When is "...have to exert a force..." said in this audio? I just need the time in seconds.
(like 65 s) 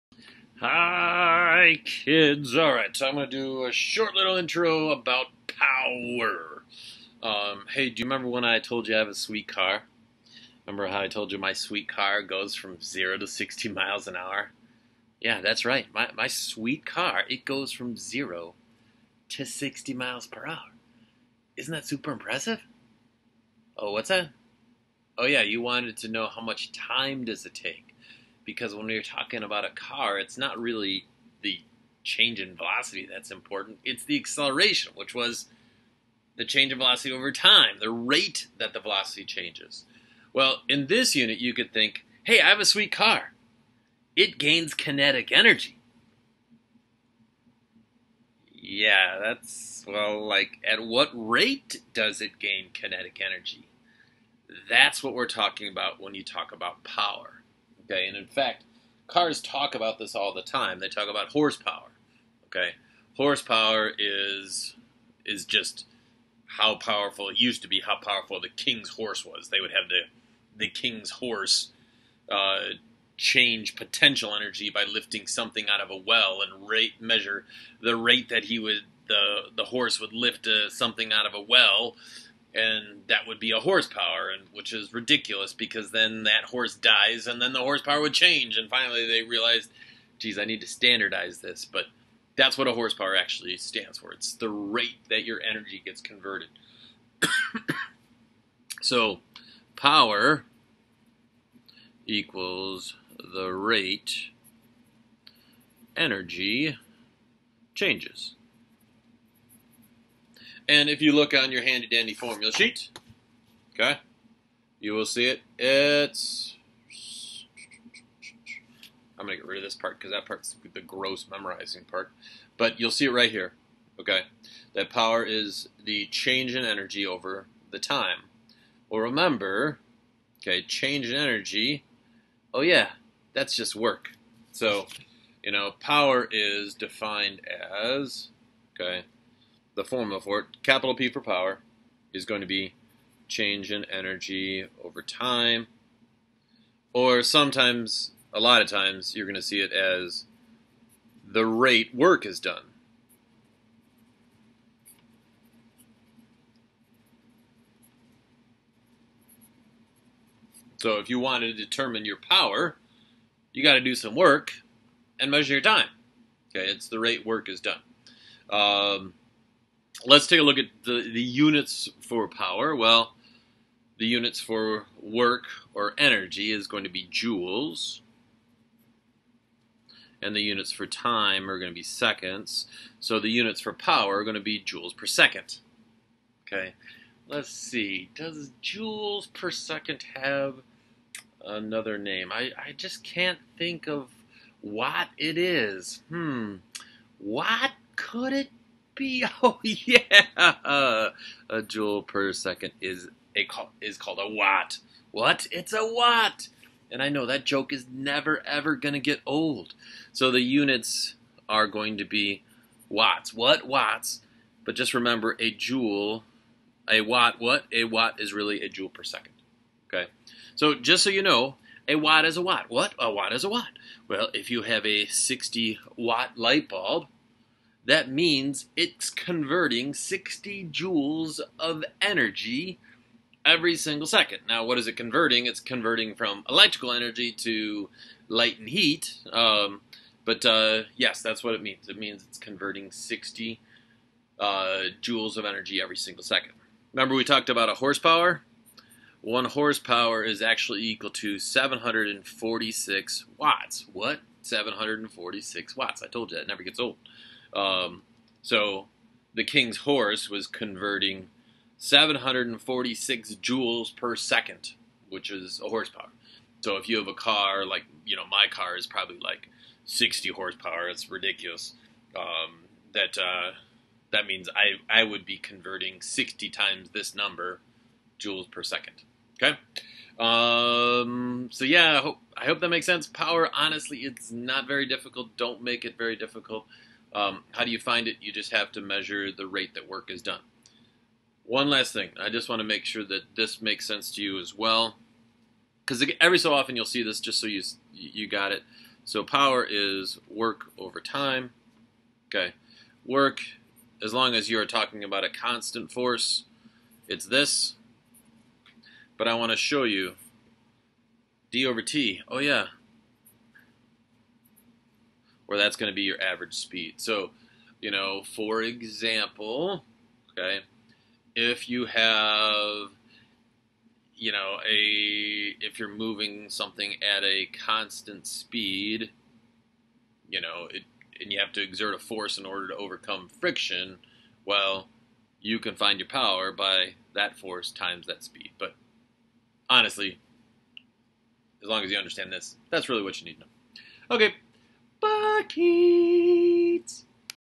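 331 s.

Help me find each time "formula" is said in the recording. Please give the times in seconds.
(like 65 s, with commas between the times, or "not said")
112 s, 139 s.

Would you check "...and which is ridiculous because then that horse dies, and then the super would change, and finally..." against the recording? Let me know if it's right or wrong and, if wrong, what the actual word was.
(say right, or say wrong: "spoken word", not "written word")
wrong: "horsepower", not "super".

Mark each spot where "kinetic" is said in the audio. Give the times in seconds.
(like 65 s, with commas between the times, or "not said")
44 s, 52 s.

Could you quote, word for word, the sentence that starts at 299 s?
So power is work over time.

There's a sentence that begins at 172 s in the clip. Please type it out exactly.
Well, the units for work or energy is going to be joules.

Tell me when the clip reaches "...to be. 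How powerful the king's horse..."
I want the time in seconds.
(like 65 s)
67 s.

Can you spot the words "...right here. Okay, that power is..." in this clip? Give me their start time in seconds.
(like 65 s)
123 s.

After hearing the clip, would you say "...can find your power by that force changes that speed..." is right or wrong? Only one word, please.
wrong.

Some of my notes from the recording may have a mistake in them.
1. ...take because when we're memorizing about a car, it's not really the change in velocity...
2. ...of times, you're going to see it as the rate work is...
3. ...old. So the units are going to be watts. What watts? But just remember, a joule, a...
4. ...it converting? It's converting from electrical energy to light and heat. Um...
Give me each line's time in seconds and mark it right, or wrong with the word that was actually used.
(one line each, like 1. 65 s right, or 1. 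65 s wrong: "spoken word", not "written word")
1. 27 s wrong: "talking", not "memorizing"
2. 148 s right
3. 209 s right
4. 234 s right.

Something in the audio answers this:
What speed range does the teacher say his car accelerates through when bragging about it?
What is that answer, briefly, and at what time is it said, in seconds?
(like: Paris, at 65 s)
0 to 60 miles per hour, at 17 s.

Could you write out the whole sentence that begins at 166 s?
Okay, it's the rate work is done.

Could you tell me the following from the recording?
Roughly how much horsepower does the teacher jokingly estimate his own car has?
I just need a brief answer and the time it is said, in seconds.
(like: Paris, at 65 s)
60 horsepower, at 269 s.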